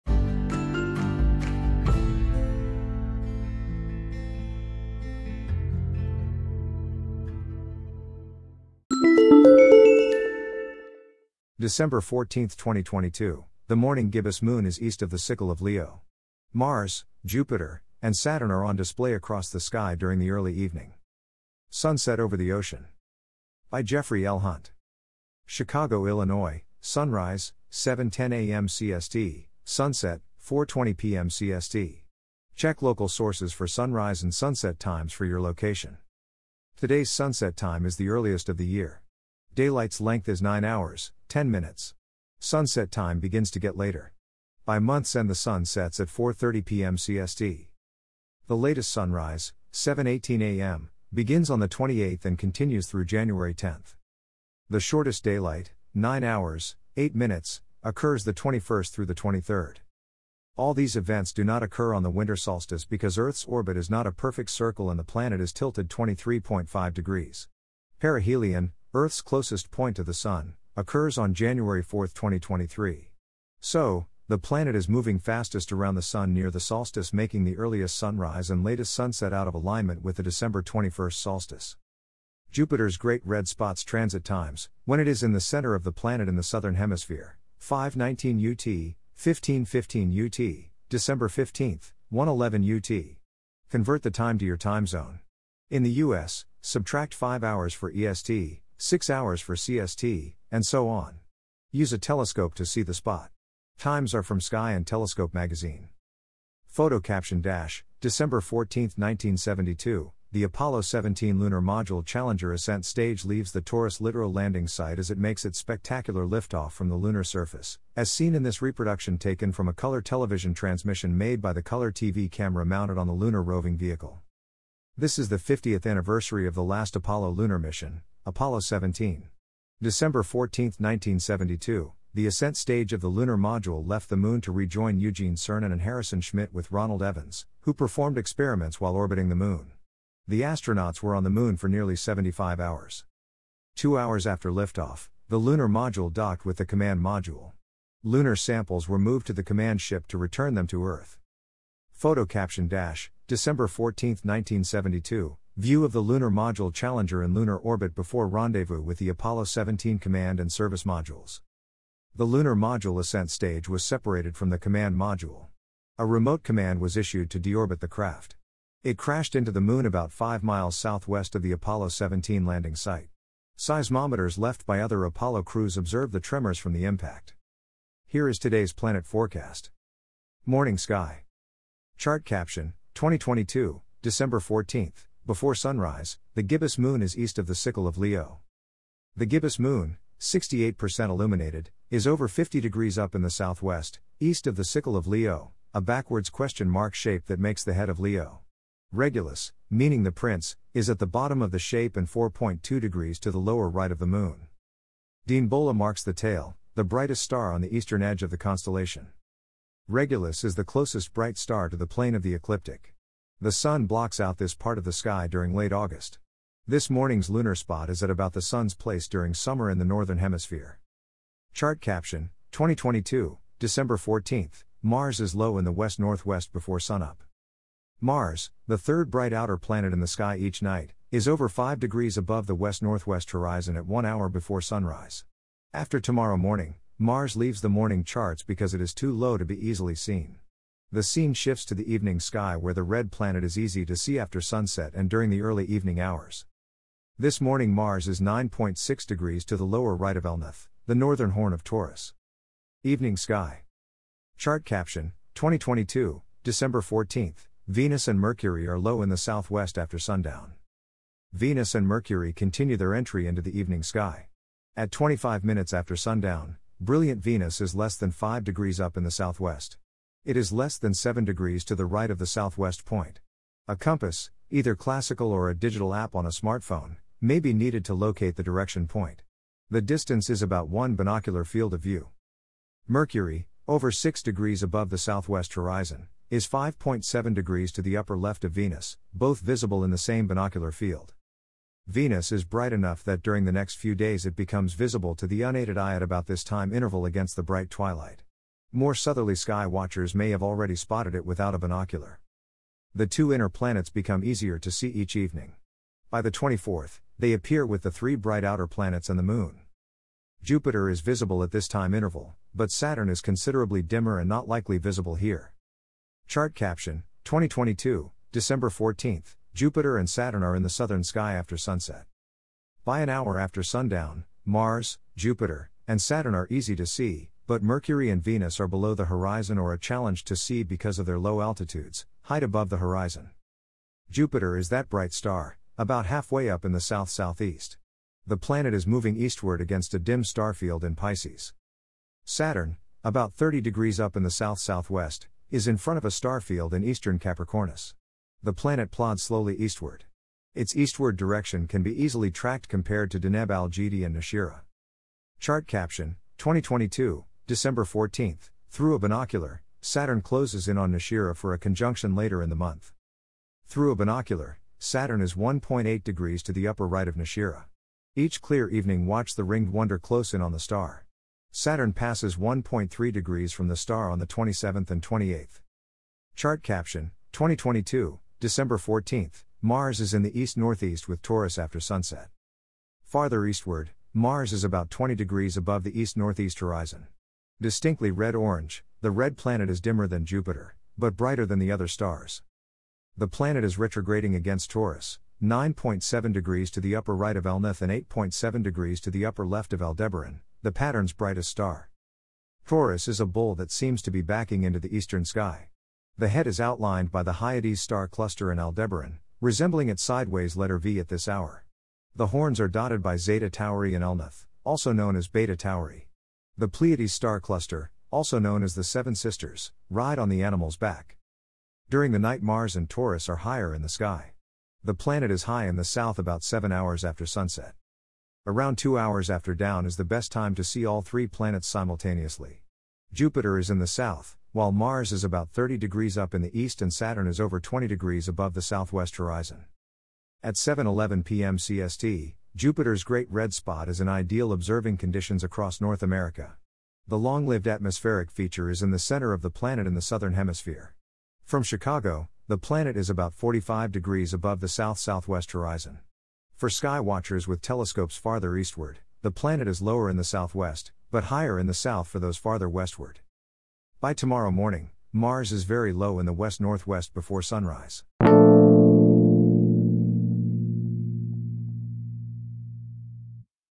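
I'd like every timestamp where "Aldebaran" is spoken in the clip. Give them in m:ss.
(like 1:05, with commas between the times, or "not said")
6:39, 6:48.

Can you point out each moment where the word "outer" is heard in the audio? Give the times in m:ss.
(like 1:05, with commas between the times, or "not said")
3:49, 5:08.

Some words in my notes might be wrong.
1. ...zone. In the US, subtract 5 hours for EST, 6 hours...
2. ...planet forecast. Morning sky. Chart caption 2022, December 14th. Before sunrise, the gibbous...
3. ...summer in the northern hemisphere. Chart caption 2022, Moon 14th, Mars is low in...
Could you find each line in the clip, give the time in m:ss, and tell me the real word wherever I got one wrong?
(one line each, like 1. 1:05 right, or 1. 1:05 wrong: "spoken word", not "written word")
1. 1:34 right
2. 2:58 right
3. 3:39 wrong: "December", not "Moon".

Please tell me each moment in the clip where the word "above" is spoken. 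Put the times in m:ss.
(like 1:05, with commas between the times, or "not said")
3:52, 4:44, 5:32, 6:25, 7:18, 7:34.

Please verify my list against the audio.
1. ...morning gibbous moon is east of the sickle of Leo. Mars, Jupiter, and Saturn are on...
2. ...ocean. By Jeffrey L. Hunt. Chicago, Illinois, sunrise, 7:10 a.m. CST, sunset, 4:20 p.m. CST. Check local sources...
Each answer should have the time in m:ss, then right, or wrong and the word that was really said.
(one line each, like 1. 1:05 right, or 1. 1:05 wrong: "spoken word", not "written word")
1. 0:13 right
2. 0:22 right.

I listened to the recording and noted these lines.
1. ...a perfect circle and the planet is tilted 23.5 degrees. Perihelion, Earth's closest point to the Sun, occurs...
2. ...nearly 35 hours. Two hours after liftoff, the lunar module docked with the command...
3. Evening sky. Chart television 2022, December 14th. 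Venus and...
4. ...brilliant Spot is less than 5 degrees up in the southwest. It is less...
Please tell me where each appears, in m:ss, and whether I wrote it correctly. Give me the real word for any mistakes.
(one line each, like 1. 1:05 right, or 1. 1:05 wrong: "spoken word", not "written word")
1. 1:04 right
2. 2:21 wrong: "75", not "35"
3. 4:12 wrong: "caption", not "television"
4. 4:26 wrong: "Venus", not "Spot".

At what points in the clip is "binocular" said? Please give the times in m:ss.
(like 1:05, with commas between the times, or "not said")
4:40, 4:50, 5:01, 5:58, 6:03.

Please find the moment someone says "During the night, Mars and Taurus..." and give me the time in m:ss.
7:01.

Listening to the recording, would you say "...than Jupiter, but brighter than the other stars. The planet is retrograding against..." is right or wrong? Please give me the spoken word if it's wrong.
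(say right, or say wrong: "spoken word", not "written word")
right.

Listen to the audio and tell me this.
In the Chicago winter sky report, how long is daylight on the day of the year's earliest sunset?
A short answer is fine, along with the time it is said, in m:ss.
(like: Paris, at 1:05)
9 hours, 10 minutes, at 0:40.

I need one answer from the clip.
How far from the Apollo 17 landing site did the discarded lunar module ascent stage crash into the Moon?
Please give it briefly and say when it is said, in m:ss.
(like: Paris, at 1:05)
About 5 miles, at 2:49.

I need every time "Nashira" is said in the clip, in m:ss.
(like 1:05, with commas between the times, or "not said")
5:54, 6:00, 6:07.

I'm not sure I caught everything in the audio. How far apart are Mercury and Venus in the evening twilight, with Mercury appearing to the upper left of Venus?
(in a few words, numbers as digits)
5.7 degrees.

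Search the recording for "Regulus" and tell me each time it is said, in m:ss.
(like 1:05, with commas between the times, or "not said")
3:18, 3:29.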